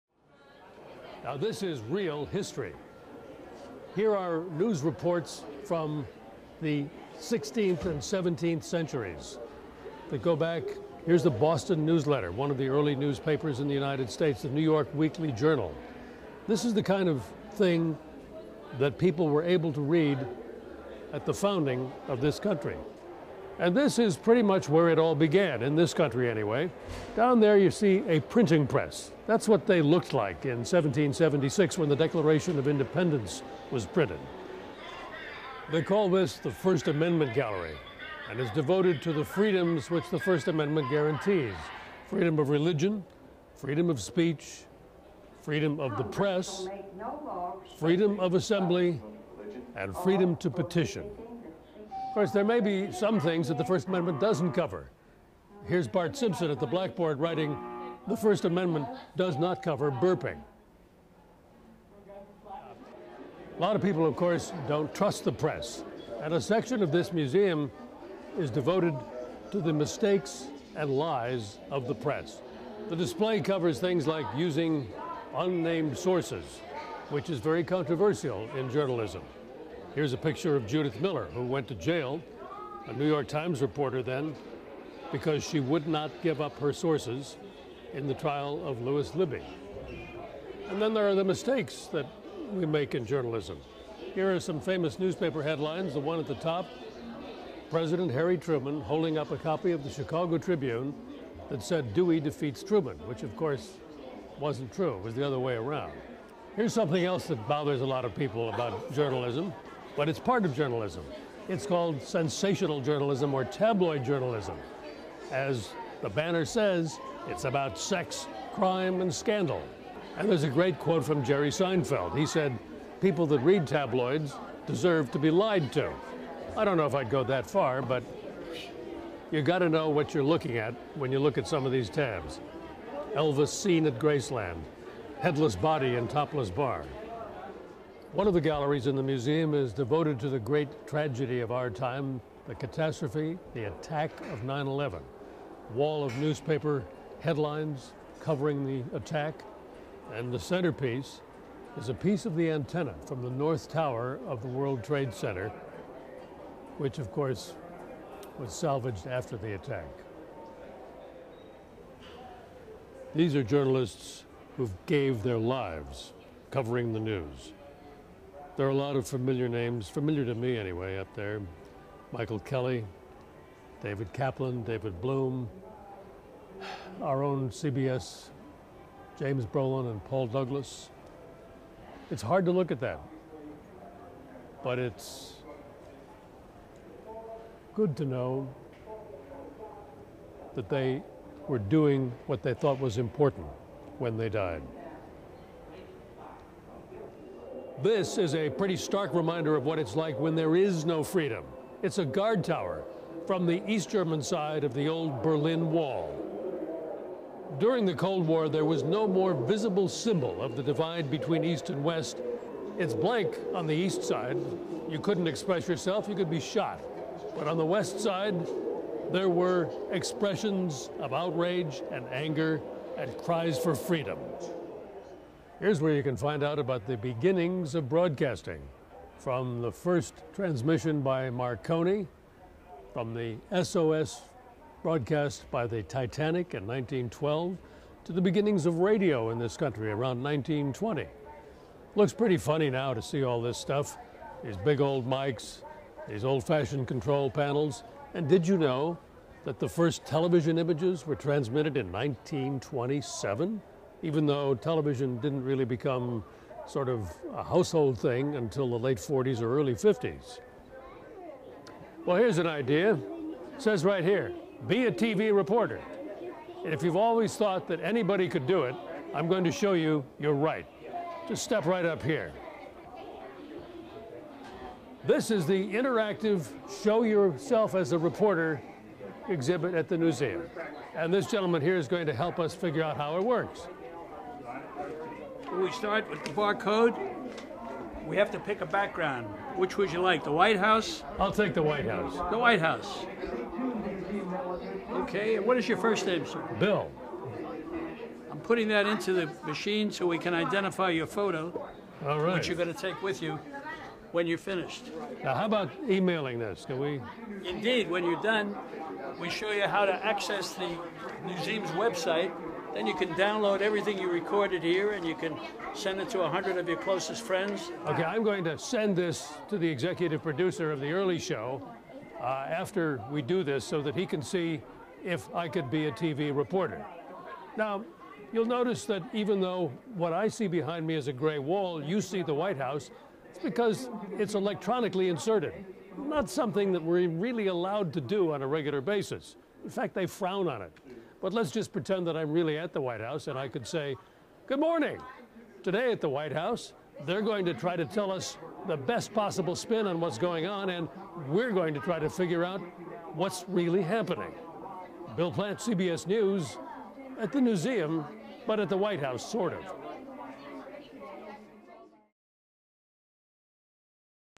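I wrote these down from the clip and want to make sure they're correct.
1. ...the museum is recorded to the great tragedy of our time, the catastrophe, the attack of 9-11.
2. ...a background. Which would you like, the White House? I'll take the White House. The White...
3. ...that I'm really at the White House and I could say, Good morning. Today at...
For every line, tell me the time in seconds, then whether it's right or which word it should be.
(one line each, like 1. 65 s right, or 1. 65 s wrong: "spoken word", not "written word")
1. 138 s wrong: "devoted", not "recorded"
2. 288 s right
3. 342 s right.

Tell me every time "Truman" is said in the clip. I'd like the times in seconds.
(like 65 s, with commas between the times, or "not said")
98 s, 102 s.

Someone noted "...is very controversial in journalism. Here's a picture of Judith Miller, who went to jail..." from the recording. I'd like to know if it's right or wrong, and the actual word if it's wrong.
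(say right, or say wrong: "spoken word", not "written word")
right.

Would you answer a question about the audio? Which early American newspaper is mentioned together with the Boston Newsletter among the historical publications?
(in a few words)
New York Weekly Journal.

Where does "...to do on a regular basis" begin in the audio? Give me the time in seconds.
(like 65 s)
337 s.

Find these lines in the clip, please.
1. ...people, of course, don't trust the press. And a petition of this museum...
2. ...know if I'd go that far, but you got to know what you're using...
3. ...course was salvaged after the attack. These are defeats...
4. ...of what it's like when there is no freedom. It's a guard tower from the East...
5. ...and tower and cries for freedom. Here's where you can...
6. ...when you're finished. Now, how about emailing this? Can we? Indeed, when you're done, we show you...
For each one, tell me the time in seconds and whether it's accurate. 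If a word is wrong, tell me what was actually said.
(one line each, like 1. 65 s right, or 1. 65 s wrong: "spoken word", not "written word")
1. 63 s wrong: "section", not "petition"
2. 126 s wrong: "looking", not "using"
3. 157 s wrong: "journalists", not "defeats"
4. 199 s right
5. 221 s wrong: "anger", not "tower"
6. 304 s right.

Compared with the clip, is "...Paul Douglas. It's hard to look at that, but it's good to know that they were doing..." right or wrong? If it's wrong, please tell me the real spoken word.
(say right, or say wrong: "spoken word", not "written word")
right.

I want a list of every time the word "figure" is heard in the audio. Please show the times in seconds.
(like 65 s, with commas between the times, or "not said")
282 s, 352 s.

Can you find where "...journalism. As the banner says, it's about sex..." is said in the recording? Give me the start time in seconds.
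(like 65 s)
114 s.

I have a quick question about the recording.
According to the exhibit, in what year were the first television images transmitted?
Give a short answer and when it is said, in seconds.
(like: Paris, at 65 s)
1927, at 251 s.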